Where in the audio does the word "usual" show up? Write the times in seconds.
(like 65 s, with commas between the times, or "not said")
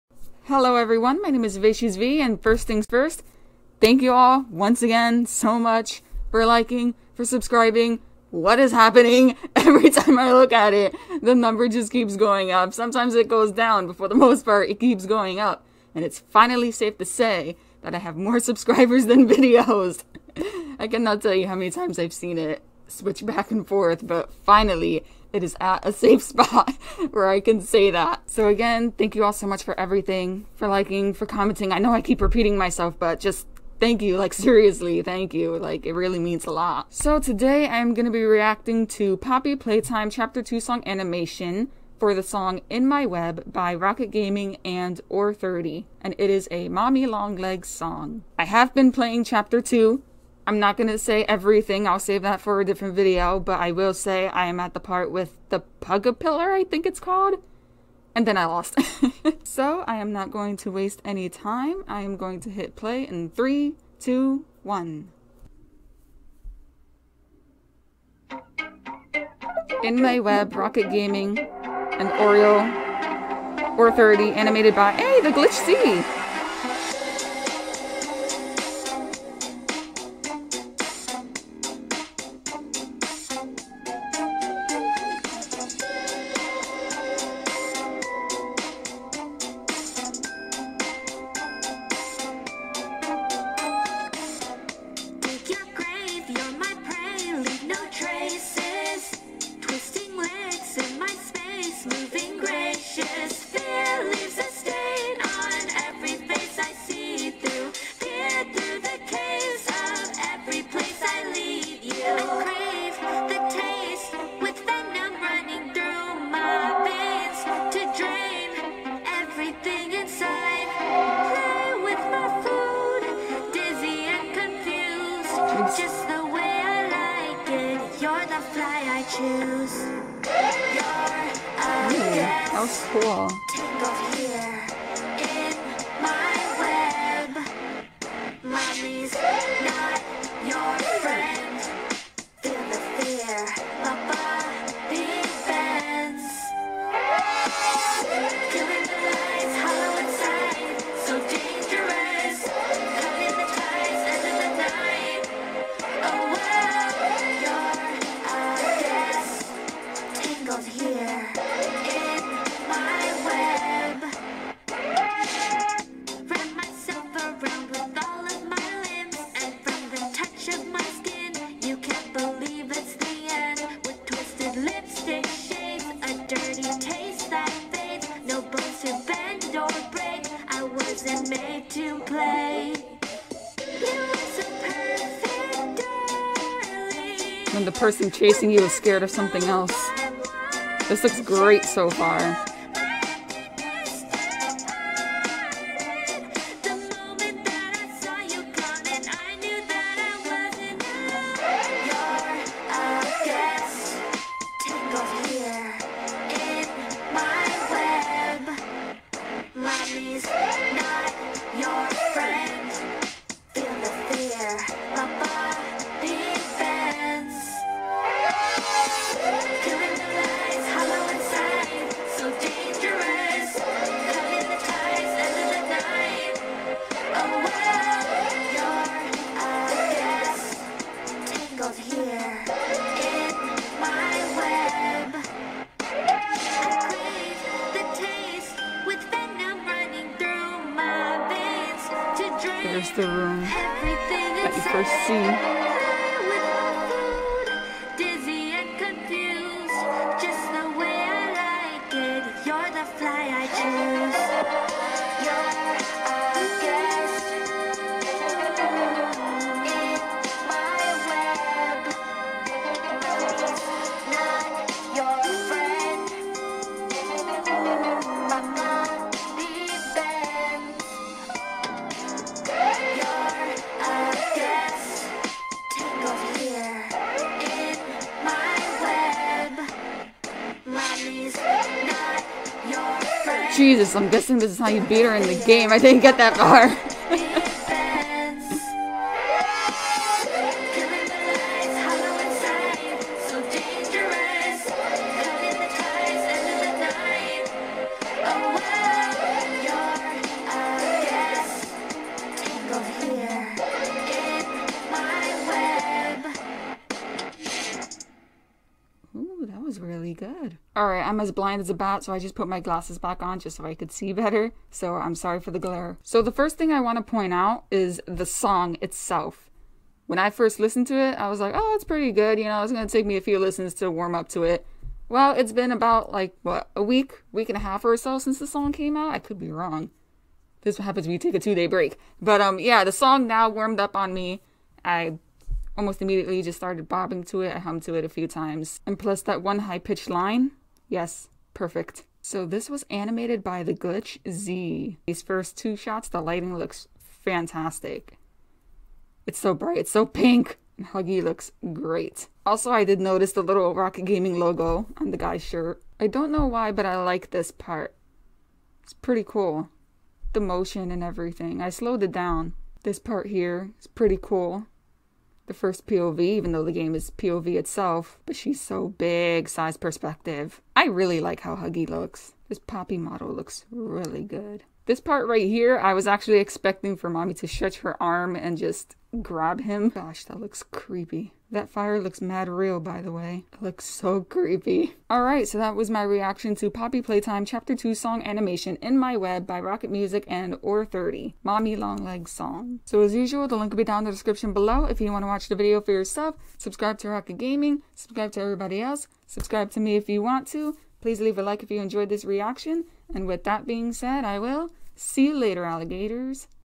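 393 s.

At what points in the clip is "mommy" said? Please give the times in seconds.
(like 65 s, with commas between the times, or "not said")
46 s, 377 s, 391 s.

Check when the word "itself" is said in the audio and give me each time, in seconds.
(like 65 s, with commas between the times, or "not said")
318 s, 367 s.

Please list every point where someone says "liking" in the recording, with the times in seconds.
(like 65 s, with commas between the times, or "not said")
6 s, 30 s.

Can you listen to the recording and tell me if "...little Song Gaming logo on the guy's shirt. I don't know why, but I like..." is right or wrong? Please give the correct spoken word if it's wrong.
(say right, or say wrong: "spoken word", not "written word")
wrong: "Rockit", not "Song".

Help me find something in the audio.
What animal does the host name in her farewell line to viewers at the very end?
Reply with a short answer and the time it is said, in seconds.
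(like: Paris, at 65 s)
alligators, at 405 s.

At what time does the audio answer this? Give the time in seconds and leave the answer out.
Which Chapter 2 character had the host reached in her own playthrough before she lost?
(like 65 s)
55 s.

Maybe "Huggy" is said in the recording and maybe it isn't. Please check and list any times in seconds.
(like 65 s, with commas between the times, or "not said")
350 s, 371 s.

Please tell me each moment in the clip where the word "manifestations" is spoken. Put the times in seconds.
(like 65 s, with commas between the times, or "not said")
not said.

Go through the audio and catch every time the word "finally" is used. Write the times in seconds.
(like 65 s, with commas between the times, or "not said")
16 s, 24 s.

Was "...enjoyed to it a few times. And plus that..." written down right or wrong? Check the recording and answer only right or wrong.
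wrong.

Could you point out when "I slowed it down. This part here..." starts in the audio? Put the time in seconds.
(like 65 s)
361 s.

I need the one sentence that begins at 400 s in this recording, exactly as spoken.
Please leave a like if you enjoyed this reaction.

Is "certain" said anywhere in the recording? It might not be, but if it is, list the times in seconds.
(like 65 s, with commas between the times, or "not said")
not said.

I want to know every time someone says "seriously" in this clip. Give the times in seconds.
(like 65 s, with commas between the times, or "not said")
34 s.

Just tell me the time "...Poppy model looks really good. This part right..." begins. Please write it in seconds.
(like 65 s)
372 s.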